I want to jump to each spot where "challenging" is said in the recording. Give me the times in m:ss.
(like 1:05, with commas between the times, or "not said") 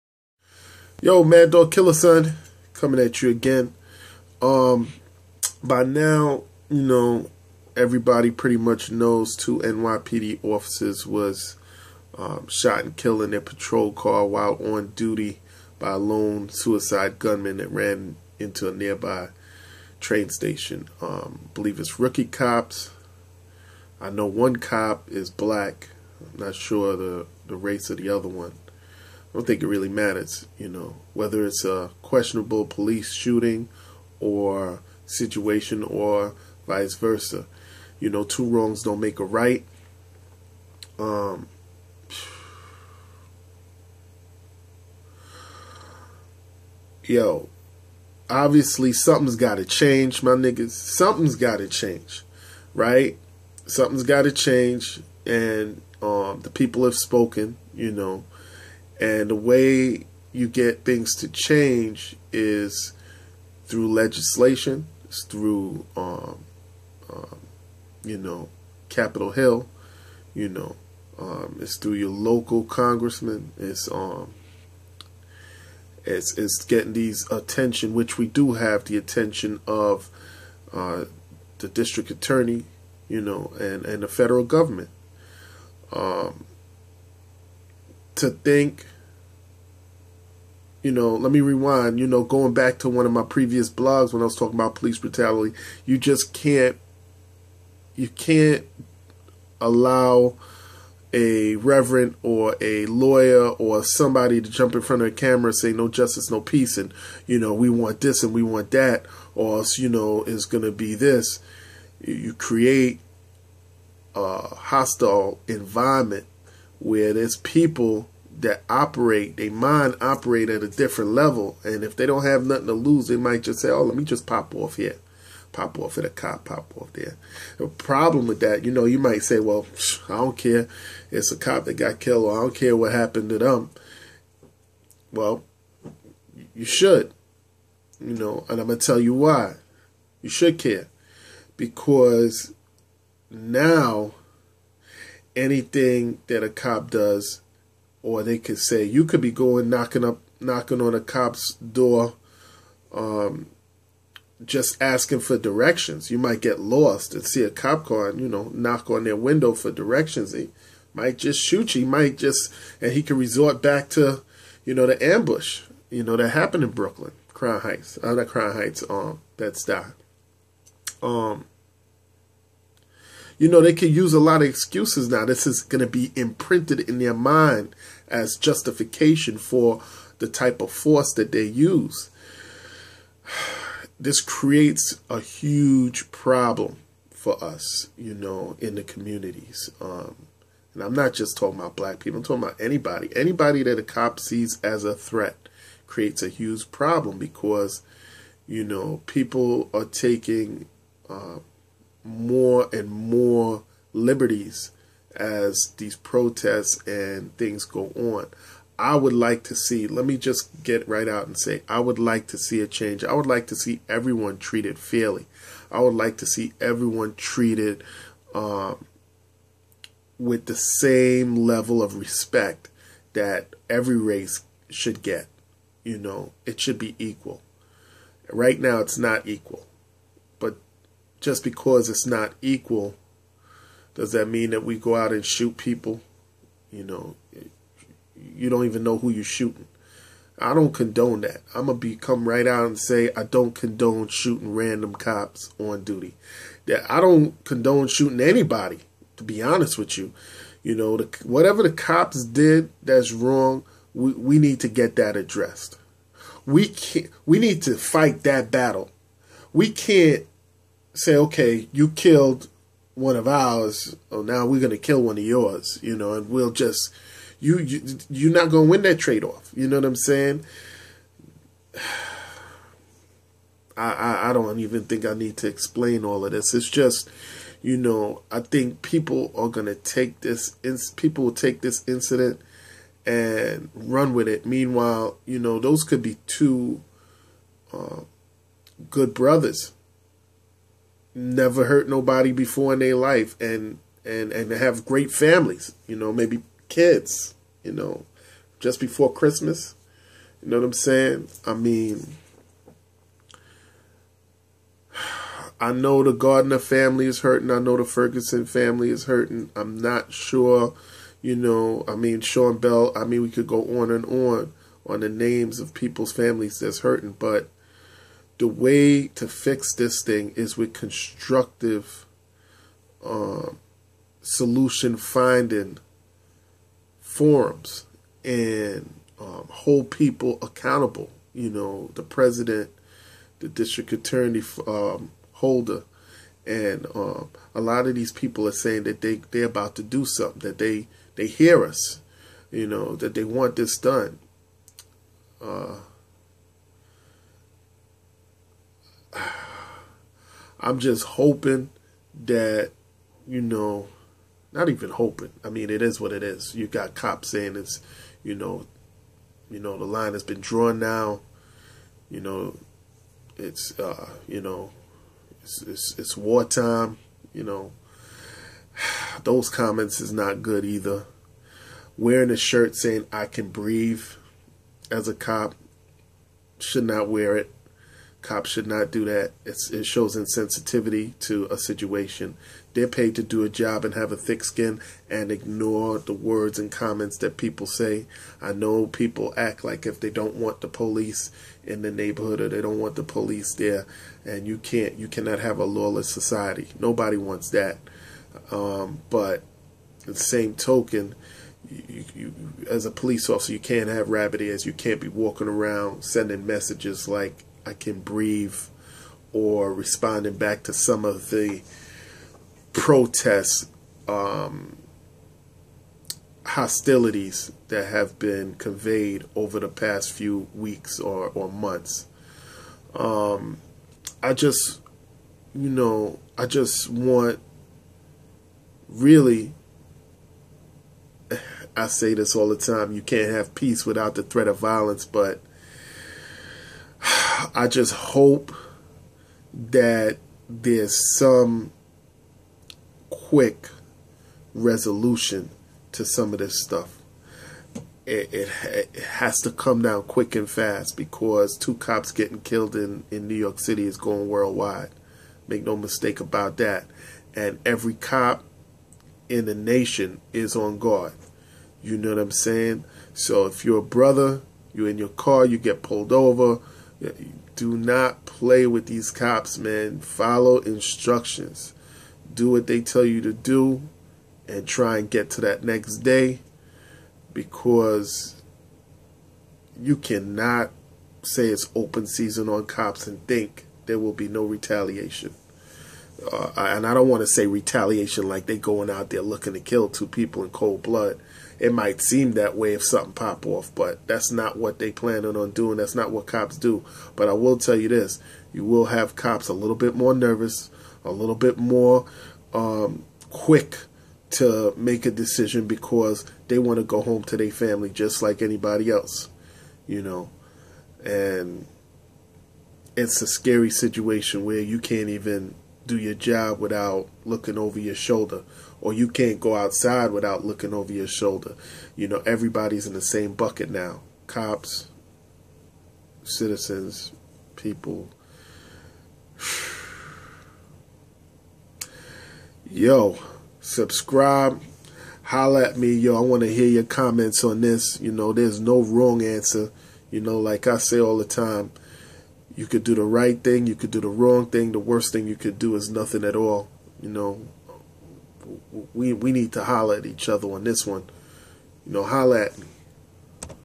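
not said.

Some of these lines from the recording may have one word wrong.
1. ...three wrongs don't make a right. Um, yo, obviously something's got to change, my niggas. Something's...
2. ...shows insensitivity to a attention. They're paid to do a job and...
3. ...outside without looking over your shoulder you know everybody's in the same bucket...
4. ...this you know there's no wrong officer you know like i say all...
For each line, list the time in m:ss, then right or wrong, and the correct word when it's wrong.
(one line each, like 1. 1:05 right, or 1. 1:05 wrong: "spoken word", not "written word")
1. 0:38 wrong: "two", not "three"
2. 6:19 wrong: "situation", not "attention"
3. 8:39 right
4. 8:57 wrong: "answer", not "officer".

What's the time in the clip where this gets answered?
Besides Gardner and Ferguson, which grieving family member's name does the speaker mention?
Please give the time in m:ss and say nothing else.
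5:12.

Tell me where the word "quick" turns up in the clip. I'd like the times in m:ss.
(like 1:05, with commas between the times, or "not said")
7:23, 7:30, 8:23.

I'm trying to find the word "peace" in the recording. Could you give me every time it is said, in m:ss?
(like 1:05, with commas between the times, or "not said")
1:46, 7:13.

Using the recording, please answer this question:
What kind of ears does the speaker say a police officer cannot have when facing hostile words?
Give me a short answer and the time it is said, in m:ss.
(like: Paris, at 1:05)
rabbit ears, at 6:44.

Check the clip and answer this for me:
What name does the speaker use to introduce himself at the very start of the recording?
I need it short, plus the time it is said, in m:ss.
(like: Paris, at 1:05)
Mad Dog Killer Son, at 0:01.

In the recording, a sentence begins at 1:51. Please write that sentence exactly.
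You create a hostile environment where there's people that operate, they mind operate at a different level.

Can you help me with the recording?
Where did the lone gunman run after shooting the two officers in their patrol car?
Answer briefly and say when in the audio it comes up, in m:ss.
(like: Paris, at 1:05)
a nearby train station, at 0:18.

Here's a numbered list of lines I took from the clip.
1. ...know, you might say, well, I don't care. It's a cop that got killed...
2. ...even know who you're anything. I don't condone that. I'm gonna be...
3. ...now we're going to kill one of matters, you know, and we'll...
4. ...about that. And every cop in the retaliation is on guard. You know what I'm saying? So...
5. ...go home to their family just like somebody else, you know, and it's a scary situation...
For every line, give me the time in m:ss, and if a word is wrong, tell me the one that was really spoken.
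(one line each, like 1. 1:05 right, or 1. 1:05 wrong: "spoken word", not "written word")
1. 2:08 right
2. 3:58 wrong: "shooting", not "anything"
3. 4:24 wrong: "yours", not "matters"
4. 7:36 wrong: "nation", not "retaliation"
5. 8:26 wrong: "anybody", not "somebody".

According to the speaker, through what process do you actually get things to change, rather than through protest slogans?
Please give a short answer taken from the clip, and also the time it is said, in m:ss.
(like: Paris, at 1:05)
legislation, at 1:03.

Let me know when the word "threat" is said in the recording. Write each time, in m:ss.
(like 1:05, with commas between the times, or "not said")
3:14, 7:14.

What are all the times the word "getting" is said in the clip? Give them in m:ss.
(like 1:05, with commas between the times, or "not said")
1:16, 7:32.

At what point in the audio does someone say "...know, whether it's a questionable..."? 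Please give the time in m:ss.
0:30.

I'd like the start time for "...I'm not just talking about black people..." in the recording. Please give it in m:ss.
3:10.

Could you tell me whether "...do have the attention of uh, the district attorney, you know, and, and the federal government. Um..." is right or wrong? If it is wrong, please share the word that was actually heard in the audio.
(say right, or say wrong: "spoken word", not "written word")
right.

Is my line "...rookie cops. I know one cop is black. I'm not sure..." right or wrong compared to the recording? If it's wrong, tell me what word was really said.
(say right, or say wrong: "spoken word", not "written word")
right.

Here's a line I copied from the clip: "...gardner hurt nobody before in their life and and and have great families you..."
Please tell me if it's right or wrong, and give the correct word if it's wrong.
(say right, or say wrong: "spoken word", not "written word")
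wrong: "never", not "gardner".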